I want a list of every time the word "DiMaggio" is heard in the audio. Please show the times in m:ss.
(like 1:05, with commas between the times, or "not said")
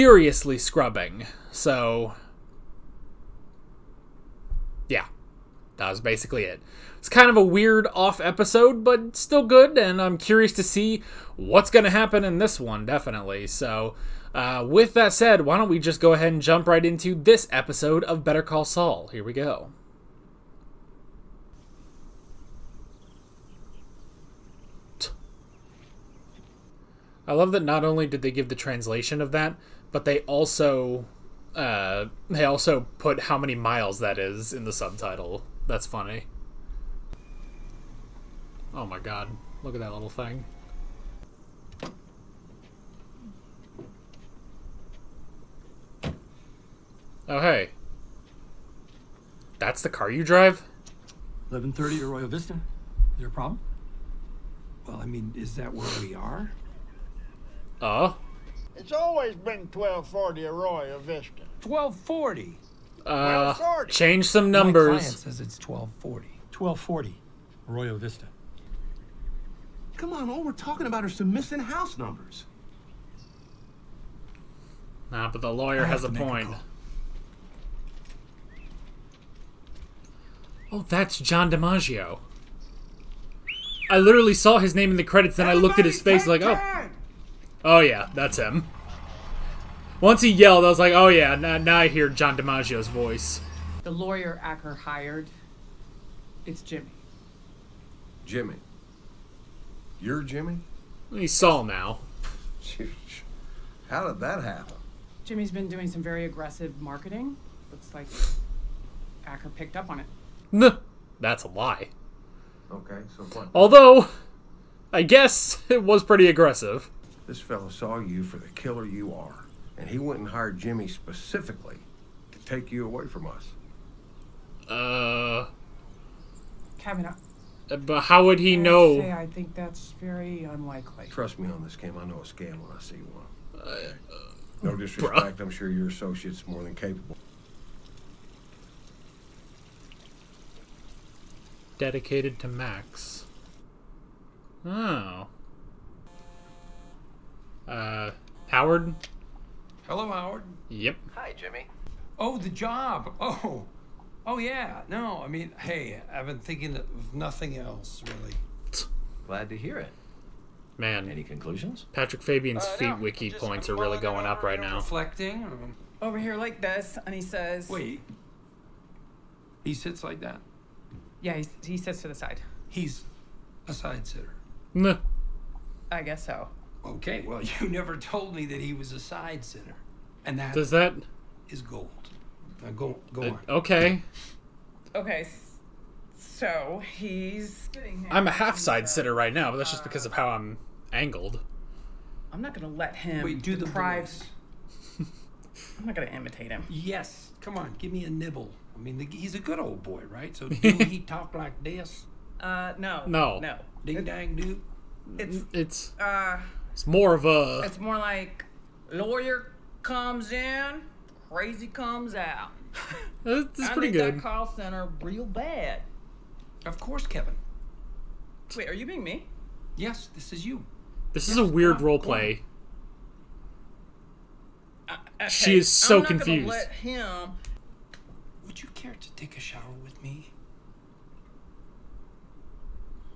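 1:21, 1:32.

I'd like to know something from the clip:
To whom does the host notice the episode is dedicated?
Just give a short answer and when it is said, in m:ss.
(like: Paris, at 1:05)
Max, at 2:22.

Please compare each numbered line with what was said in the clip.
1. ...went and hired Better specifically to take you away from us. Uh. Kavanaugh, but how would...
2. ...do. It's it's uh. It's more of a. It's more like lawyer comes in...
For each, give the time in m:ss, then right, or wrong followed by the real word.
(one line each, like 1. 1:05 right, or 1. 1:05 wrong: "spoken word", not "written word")
1. 1:59 wrong: "Jimmy", not "Better"
2. 3:24 right.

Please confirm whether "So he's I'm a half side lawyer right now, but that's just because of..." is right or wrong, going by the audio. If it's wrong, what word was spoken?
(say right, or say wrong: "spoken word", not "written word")
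wrong: "sitter", not "lawyer".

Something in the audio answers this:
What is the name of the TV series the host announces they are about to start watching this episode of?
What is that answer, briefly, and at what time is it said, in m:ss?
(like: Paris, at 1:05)
Better Call Saul, at 0:18.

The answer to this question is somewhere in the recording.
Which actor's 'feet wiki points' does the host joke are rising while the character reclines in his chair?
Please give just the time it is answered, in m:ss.
2:41.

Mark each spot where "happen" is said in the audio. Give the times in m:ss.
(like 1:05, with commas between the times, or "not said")
0:11, 1:44.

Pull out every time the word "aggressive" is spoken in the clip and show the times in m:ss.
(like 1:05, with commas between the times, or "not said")
1:46, 1:56.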